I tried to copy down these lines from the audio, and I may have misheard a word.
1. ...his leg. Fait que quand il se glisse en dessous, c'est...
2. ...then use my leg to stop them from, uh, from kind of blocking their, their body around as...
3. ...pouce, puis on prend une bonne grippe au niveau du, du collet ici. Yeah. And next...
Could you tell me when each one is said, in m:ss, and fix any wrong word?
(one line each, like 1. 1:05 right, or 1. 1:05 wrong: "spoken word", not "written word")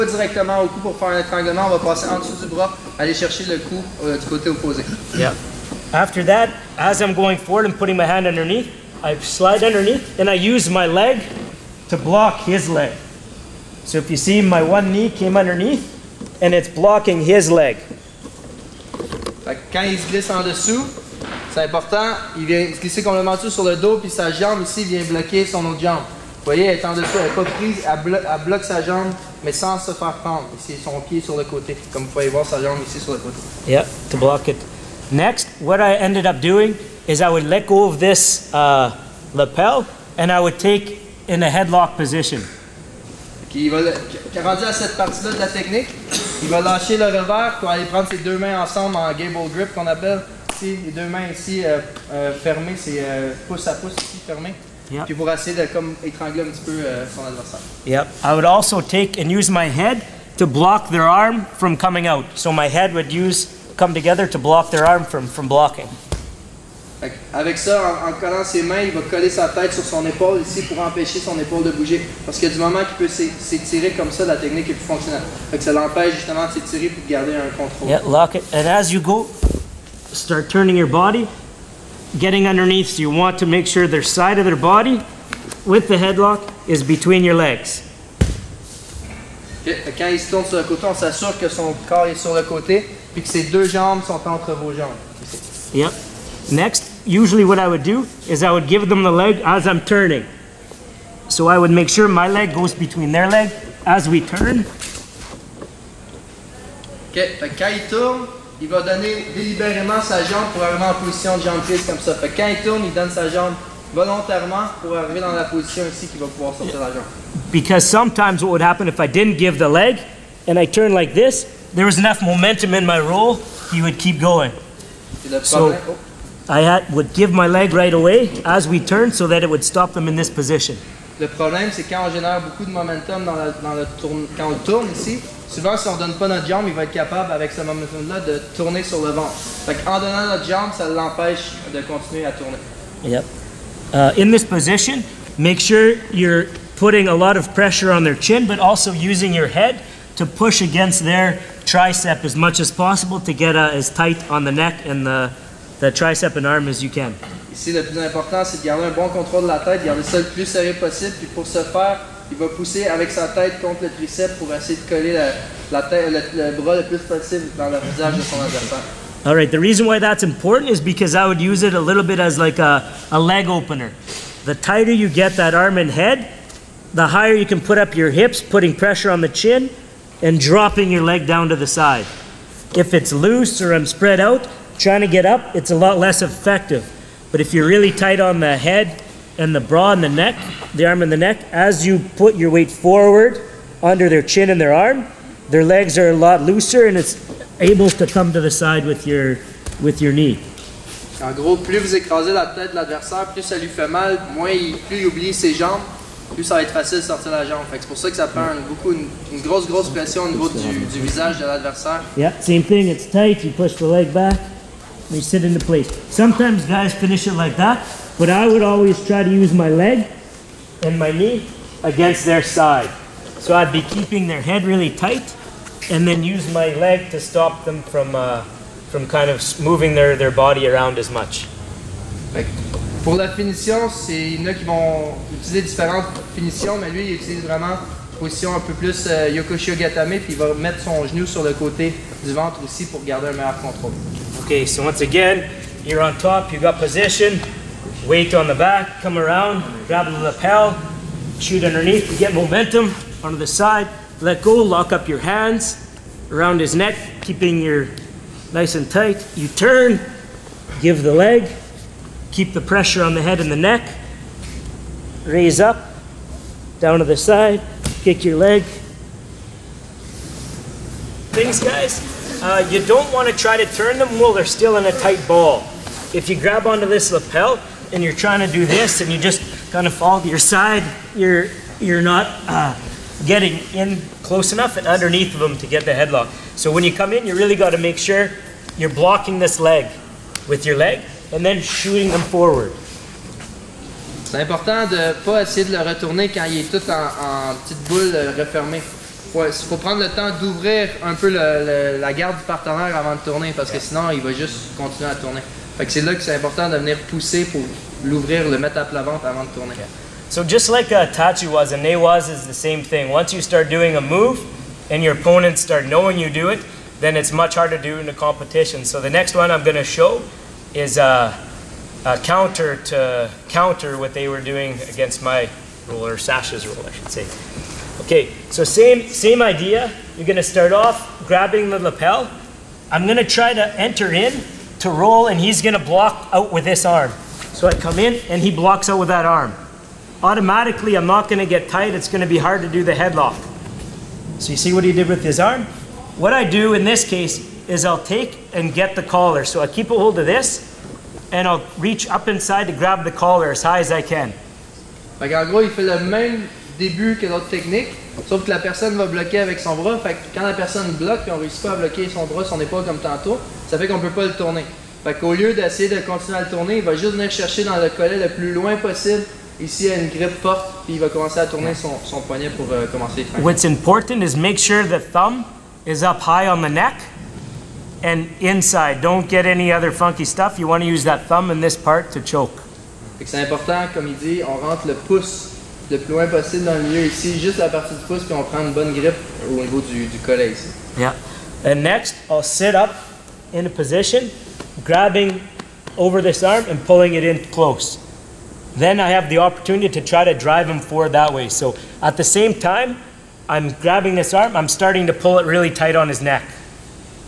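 1. 0:17 right
2. 3:46 wrong: "moving", not "blocking"
3. 6:28 right.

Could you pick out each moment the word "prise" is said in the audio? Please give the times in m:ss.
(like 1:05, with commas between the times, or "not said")
0:27, 1:51.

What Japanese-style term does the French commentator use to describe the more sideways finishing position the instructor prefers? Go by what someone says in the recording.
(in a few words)
Yokoshi.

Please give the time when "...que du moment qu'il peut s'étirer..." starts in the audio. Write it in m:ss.
1:12.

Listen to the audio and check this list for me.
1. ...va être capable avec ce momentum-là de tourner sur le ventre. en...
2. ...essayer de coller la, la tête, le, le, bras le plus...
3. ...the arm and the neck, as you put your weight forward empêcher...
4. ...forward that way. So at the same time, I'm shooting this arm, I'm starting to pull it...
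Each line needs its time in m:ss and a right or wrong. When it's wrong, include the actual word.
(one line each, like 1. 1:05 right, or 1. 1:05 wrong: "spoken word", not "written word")
1. 2:16 right
2. 2:44 right
3. 3:10 wrong: "under", not "empêcher"
4. 6:40 wrong: "grabbing", not "shooting".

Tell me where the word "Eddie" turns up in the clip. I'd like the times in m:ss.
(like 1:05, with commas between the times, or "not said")
not said.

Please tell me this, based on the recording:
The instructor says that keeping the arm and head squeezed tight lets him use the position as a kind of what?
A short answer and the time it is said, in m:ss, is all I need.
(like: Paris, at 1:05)
leg opener, at 2:53.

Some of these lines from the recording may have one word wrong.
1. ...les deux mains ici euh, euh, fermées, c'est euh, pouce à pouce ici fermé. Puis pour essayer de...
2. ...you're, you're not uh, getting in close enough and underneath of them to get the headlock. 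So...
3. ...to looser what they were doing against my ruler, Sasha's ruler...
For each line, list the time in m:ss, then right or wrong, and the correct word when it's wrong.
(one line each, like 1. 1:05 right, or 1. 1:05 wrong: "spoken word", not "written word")
1. 0:50 right
2. 4:41 right
3. 5:22 wrong: "counter", not "looser".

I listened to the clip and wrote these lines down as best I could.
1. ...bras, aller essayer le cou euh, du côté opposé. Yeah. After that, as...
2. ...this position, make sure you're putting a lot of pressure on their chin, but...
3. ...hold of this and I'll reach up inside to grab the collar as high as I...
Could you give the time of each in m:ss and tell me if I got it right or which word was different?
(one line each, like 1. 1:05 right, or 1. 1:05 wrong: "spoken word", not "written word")
1. 0:02 wrong: "chercher", not "essayer"
2. 2:24 right
3. 5:49 right.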